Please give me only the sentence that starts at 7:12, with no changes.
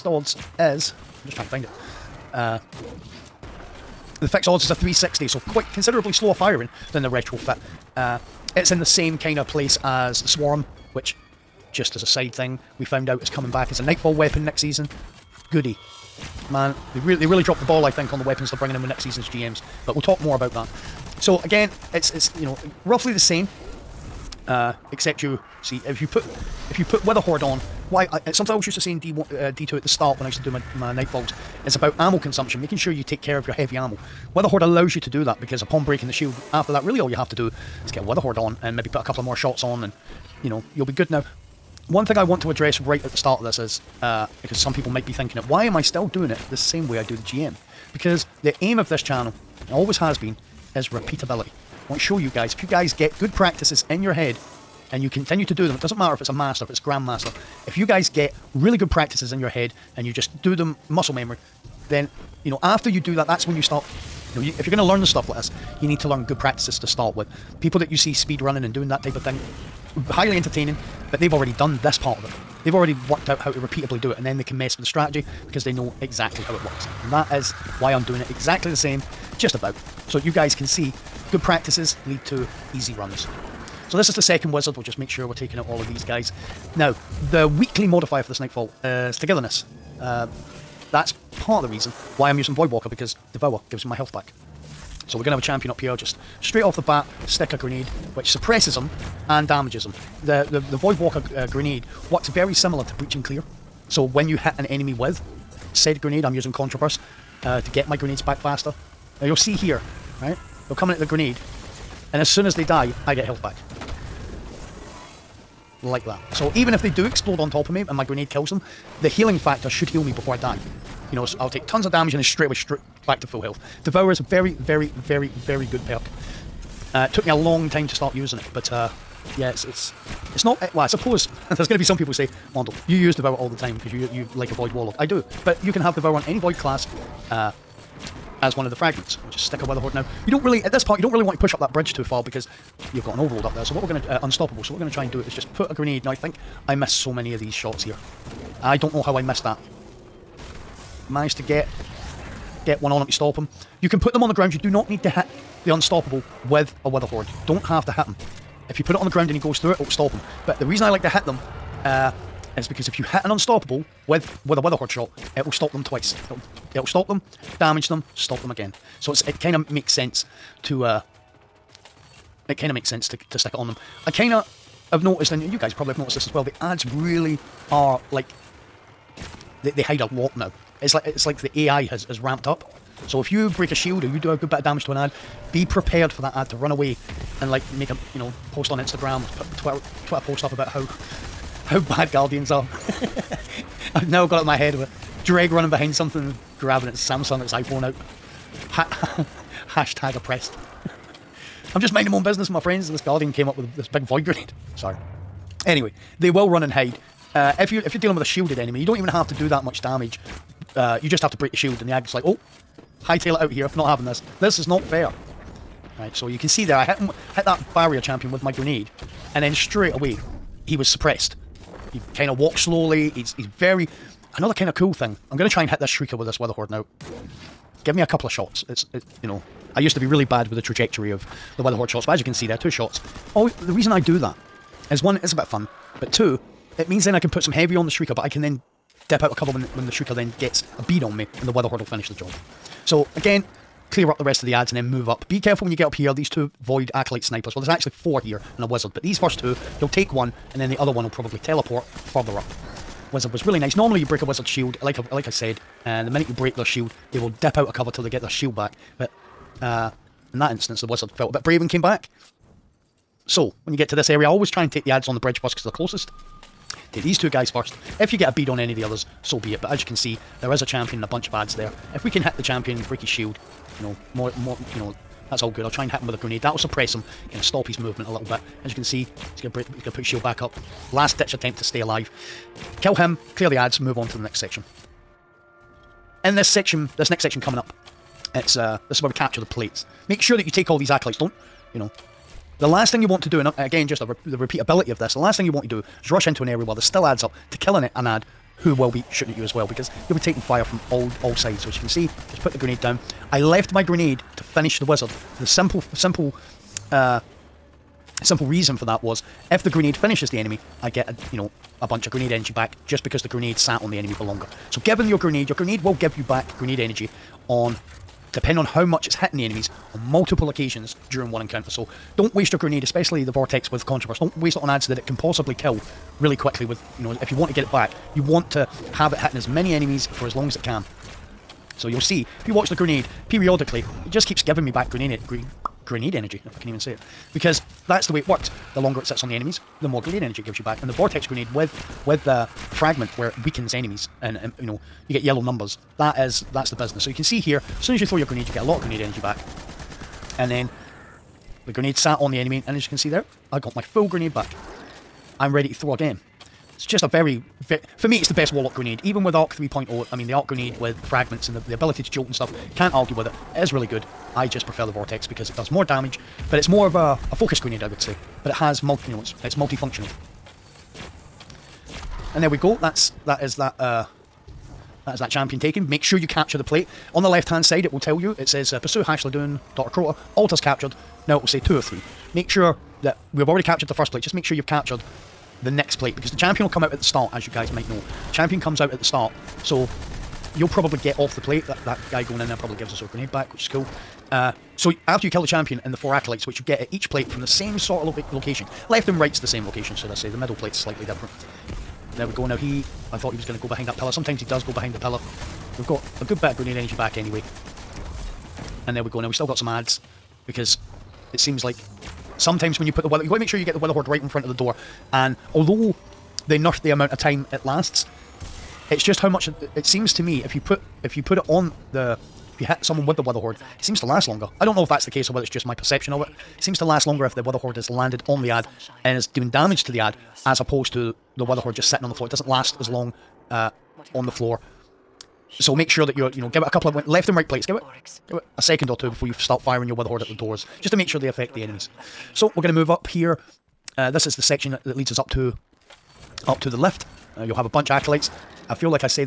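It doesn't last as long uh, on the floor.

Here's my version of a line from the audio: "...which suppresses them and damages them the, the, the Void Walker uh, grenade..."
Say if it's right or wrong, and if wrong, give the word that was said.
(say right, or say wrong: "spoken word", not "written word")
right.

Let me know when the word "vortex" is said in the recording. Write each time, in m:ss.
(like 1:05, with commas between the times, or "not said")
5:23, 5:40, 6:04.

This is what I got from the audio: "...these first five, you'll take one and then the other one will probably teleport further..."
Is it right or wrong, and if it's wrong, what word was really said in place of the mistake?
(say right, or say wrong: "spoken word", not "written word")
wrong: "two", not "five".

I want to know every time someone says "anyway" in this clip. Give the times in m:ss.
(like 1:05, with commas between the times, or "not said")
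3:25, 6:47.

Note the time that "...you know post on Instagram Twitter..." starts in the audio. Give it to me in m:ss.
3:08.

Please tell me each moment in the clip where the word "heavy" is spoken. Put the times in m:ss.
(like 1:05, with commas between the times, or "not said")
0:33, 3:57.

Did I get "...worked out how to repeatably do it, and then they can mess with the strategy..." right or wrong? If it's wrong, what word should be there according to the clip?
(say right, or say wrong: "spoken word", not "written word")
right.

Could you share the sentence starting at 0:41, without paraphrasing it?
Now, one thing I want to address right at the start of this is uh, because some people might be thinking it.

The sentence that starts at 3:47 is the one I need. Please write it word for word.
Give me a couple of shots.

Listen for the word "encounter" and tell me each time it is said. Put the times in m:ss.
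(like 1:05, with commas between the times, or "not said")
5:21.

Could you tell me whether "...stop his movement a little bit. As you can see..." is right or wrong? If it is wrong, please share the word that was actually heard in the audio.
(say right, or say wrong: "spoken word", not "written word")
right.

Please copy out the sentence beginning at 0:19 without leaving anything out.
But we'll talk more about that.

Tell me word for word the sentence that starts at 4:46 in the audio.
In this section, this next section coming up, it's uh, this is where we capture the plates.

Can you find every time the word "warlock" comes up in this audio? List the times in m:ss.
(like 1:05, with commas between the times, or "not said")
2:14, 5:58.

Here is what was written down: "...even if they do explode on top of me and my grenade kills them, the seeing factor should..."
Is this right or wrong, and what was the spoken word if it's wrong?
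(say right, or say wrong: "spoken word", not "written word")
wrong: "healing", not "seeing".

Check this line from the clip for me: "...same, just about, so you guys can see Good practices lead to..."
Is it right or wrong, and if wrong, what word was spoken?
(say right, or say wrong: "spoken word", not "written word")
right.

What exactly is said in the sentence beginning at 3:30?
Uh, you just have to break the shield, and the ag's like, oh, hightail it out here.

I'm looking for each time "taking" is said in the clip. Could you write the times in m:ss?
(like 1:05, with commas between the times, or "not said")
1:25, 5:00.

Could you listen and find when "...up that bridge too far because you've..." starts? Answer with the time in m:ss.
2:21.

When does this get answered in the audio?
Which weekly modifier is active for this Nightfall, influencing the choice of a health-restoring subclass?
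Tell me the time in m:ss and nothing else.
1:29.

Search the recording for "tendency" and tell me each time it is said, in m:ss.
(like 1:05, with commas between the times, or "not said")
not said.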